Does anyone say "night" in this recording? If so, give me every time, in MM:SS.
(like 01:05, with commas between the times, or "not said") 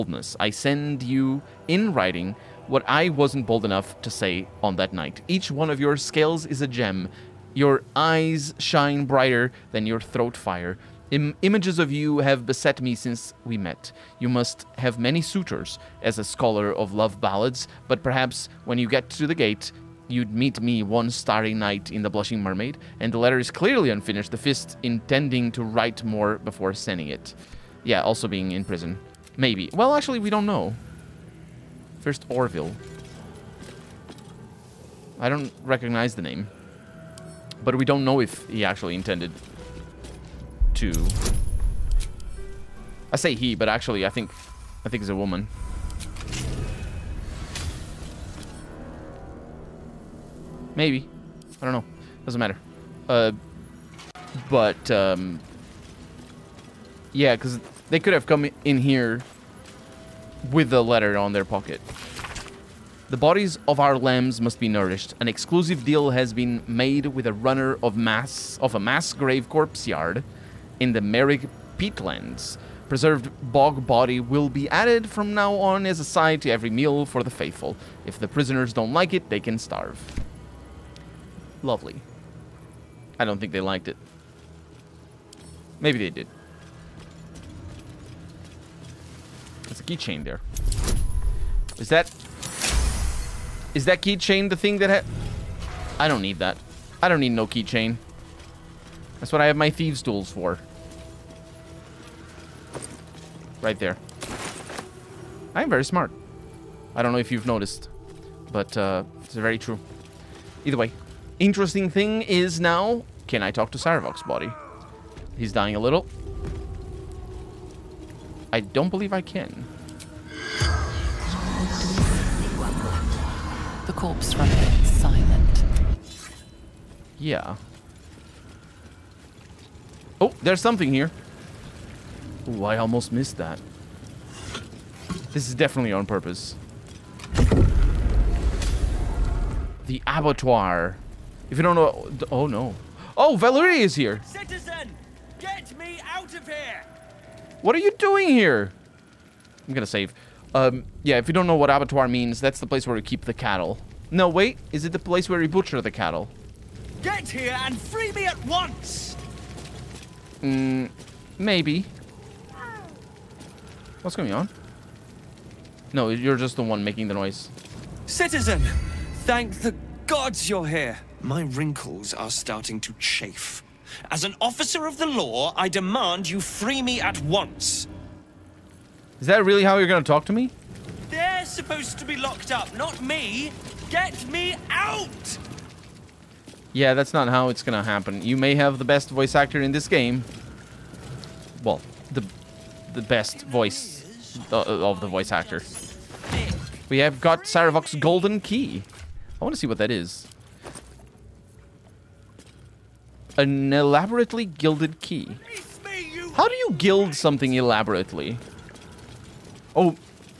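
00:04, 00:21.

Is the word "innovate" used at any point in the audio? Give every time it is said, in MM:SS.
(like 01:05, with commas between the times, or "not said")
not said.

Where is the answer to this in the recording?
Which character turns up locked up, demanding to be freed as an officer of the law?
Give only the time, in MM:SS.
02:23.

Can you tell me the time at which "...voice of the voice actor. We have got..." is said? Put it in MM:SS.
03:13.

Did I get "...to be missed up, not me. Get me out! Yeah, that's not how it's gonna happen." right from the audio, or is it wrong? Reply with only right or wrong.
wrong.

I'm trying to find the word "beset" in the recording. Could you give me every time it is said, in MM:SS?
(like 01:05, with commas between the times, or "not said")
00:12.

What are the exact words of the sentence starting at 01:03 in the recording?
The bodies of our lambs must be nourished.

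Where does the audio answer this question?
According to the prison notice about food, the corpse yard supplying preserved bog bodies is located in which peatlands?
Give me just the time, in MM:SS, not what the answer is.
01:11.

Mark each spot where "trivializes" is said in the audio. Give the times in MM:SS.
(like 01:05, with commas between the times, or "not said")
not said.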